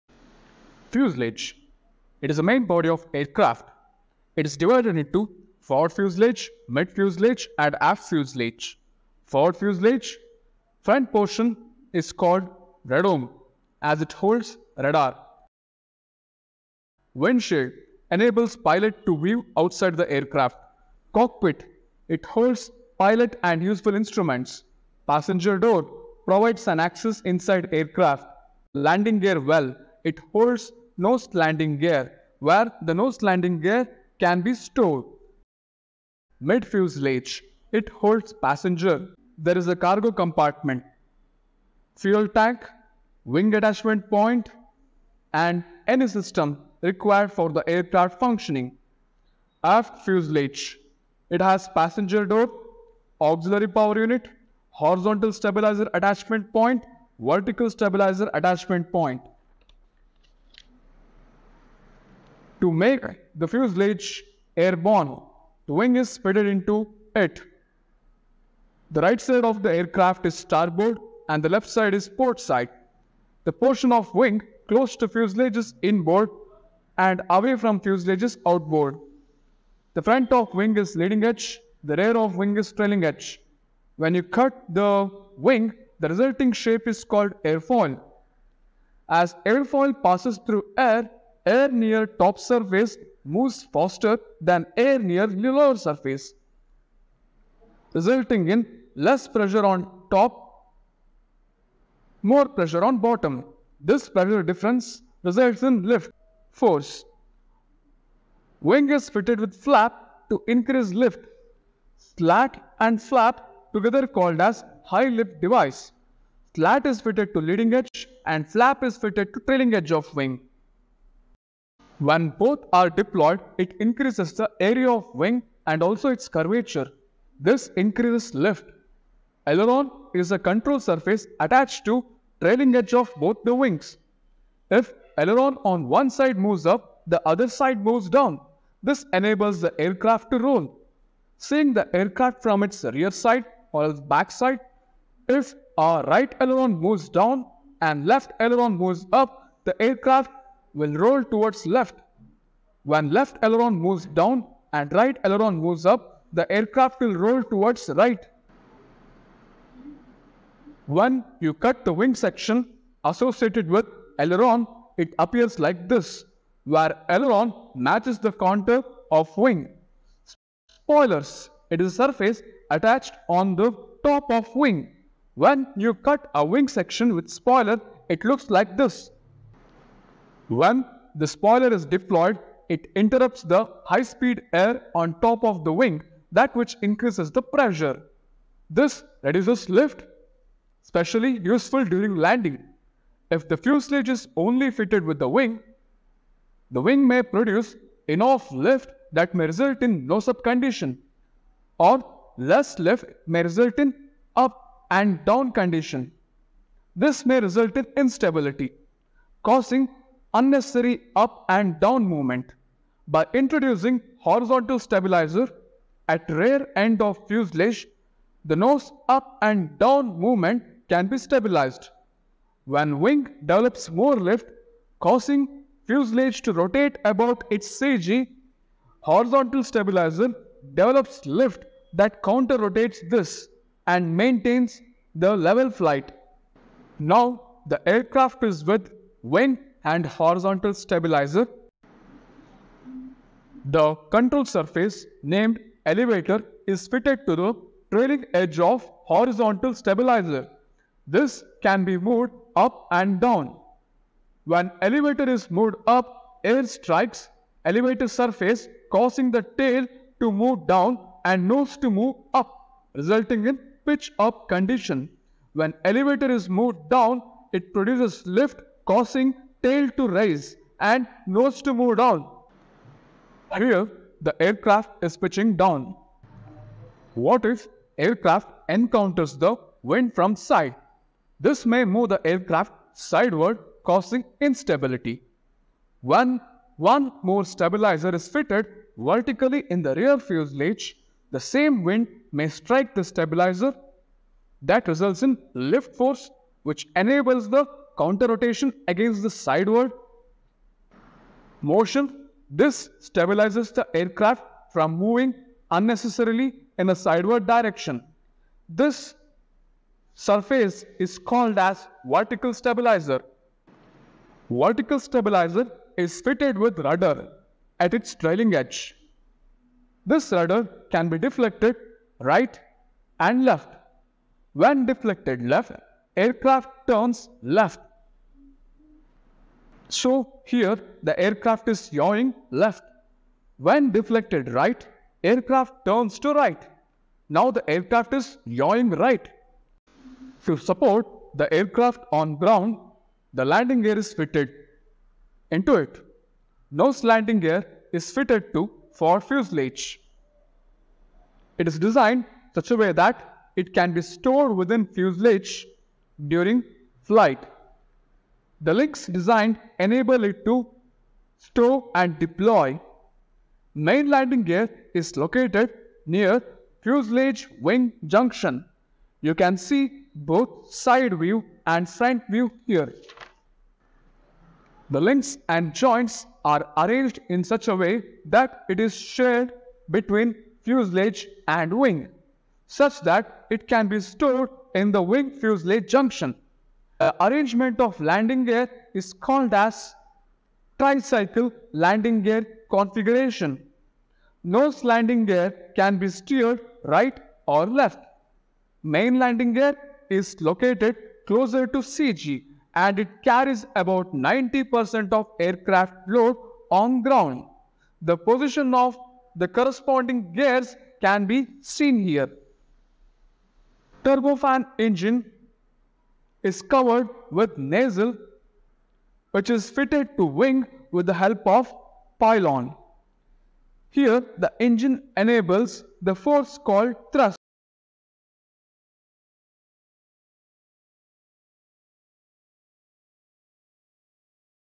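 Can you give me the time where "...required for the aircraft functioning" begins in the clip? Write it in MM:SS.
00:46.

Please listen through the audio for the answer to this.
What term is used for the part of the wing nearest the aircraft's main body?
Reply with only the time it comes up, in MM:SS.
01:15.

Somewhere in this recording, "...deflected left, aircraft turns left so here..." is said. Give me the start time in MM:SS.
05:24.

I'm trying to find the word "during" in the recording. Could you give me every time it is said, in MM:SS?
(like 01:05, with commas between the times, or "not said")
03:11, 05:56.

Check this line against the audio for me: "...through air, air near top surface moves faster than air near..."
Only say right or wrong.
right.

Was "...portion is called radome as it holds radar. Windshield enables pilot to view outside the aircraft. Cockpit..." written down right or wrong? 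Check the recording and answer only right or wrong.
right.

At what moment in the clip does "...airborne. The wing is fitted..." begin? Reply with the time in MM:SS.
01:04.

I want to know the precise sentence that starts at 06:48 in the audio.
The position of the corresponding gears can be seen here.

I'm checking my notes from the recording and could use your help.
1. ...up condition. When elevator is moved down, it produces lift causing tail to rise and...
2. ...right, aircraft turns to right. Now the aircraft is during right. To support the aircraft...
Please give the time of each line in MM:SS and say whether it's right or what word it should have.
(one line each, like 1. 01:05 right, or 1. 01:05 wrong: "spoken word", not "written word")
1. 04:24 right
2. 05:34 wrong: "yawing", not "during".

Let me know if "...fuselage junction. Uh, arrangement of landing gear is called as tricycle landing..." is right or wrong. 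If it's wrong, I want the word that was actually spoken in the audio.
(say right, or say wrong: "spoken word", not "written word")
right.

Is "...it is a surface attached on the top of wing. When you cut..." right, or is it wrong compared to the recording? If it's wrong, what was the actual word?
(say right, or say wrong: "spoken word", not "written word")
right.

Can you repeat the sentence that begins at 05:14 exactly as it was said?
Vertical stabilizer is fitted with rudder at its trailing edge.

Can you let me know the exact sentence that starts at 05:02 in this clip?
This stabilizes the aircraft from moving unnecessarily in a sideward direction.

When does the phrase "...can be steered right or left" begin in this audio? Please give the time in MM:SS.
06:35.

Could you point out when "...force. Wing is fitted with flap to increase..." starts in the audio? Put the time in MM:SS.
01:46.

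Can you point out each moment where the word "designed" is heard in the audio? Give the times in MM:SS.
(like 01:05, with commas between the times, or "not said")
05:51, 05:59.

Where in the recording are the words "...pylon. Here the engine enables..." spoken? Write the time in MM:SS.
07:02.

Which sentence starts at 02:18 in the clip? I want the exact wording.
This enables the aircraft to roll.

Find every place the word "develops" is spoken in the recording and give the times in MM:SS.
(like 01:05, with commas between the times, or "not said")
03:43, 03:50.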